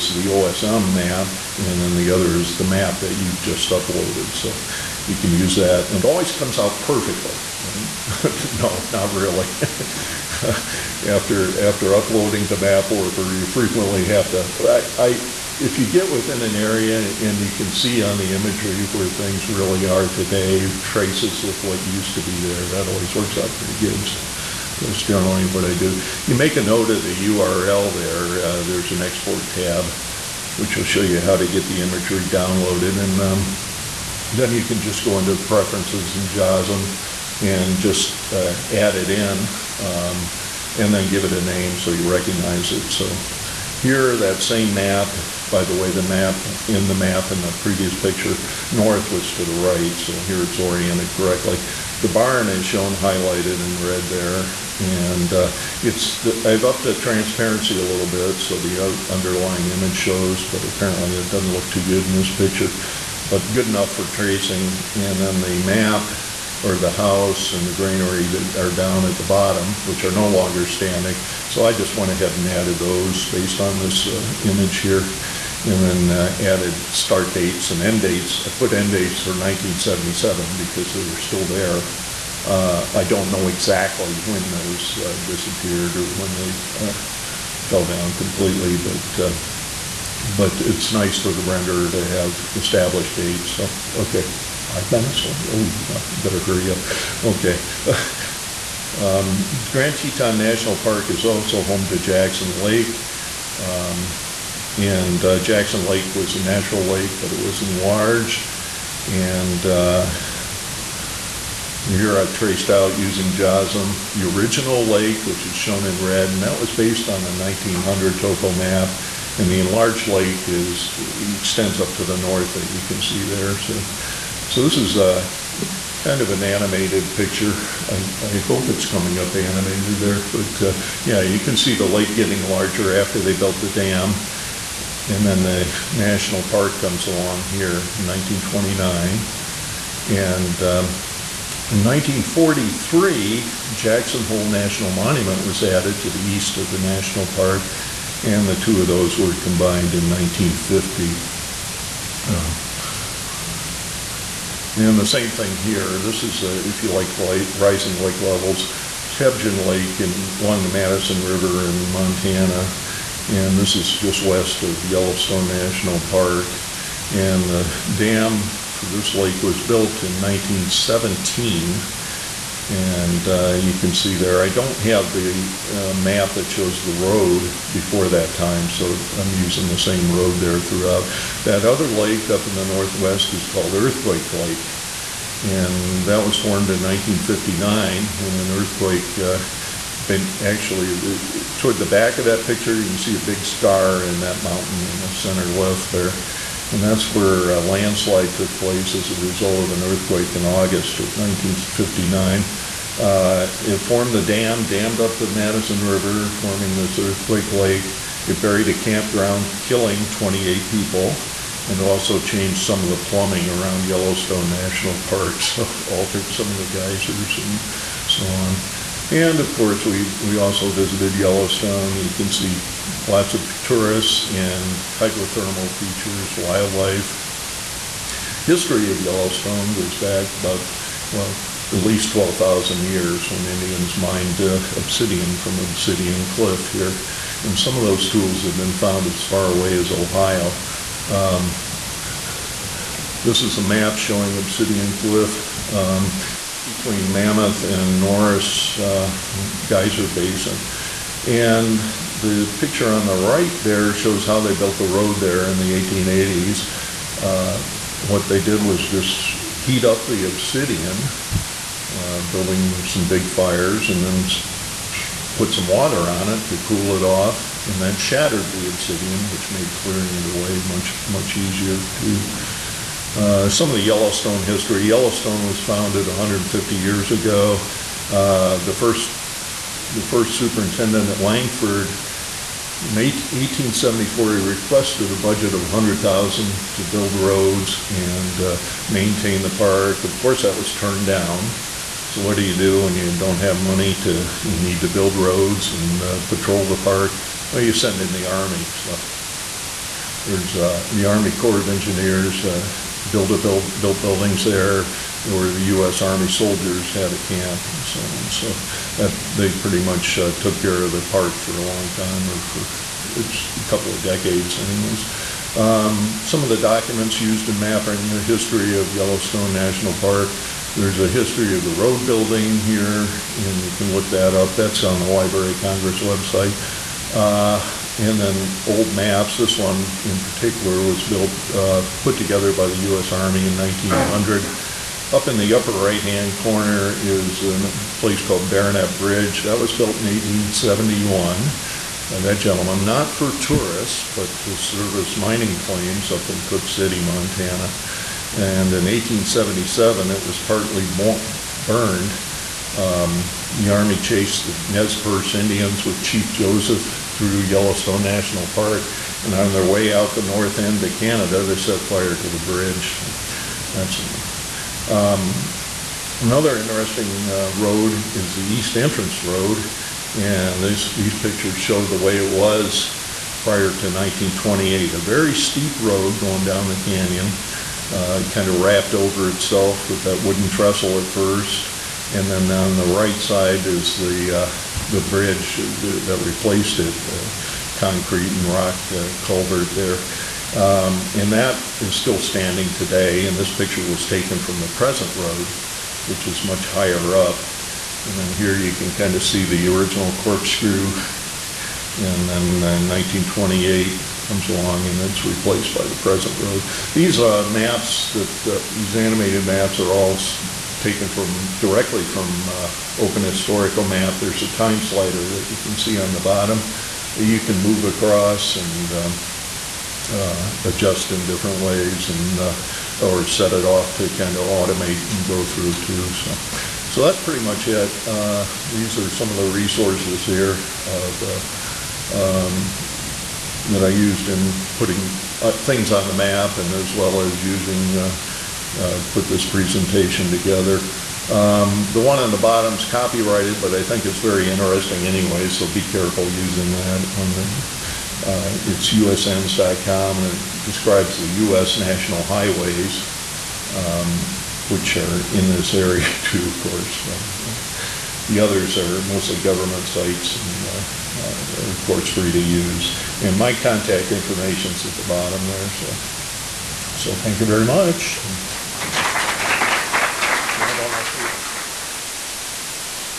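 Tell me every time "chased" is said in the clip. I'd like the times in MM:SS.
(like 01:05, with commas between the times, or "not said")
05:53.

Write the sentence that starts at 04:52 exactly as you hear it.
So what do you do when you don't have money to you need to build roads and uh, patrol the park?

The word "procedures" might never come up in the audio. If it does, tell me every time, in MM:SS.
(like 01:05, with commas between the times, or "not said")
not said.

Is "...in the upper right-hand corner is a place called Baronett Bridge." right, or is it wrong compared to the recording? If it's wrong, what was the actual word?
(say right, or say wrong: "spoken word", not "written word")
right.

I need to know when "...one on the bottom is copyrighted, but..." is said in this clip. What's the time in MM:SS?
07:22.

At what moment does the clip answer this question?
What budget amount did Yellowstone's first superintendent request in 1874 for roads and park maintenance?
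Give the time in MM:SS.
04:45.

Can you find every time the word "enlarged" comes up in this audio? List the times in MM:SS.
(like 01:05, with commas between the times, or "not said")
01:47, 01:59.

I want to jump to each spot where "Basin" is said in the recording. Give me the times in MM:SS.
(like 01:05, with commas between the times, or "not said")
04:10.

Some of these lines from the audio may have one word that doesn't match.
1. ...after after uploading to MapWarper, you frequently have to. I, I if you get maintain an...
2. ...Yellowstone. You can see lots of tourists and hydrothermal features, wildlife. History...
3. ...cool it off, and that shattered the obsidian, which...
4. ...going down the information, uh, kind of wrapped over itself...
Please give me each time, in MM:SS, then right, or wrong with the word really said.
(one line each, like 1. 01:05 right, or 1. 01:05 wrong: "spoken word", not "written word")
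1. 00:11 wrong: "within", not "maintain"
2. 03:41 right
3. 04:26 right
4. 06:16 wrong: "canyon", not "information".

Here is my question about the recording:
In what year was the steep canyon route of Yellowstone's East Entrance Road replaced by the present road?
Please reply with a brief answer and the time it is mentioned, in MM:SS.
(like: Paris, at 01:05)
1928, at 06:42.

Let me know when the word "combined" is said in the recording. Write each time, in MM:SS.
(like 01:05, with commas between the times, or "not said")
02:29.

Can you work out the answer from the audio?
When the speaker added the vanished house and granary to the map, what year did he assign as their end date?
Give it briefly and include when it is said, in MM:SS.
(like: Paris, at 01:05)
1977, at 01:19.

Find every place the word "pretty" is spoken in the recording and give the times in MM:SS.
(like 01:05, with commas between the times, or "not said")
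00:23, 05:09, 07:07.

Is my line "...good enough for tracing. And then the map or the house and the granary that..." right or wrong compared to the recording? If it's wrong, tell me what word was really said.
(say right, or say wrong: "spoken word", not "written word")
right.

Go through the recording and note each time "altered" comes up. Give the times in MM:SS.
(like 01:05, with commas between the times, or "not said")
03:35.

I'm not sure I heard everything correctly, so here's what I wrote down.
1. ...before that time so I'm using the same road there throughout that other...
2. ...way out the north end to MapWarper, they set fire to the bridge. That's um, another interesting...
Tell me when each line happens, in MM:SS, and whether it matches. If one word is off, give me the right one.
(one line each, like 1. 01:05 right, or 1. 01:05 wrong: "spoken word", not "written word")
1. 02:57 right
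2. 05:59 wrong: "Canada", not "MapWarper".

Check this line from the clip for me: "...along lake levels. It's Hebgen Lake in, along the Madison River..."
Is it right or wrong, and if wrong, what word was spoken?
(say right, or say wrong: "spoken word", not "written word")
wrong: "rising", not "along".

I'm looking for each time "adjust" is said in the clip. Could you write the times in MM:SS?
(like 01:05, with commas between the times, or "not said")
07:00.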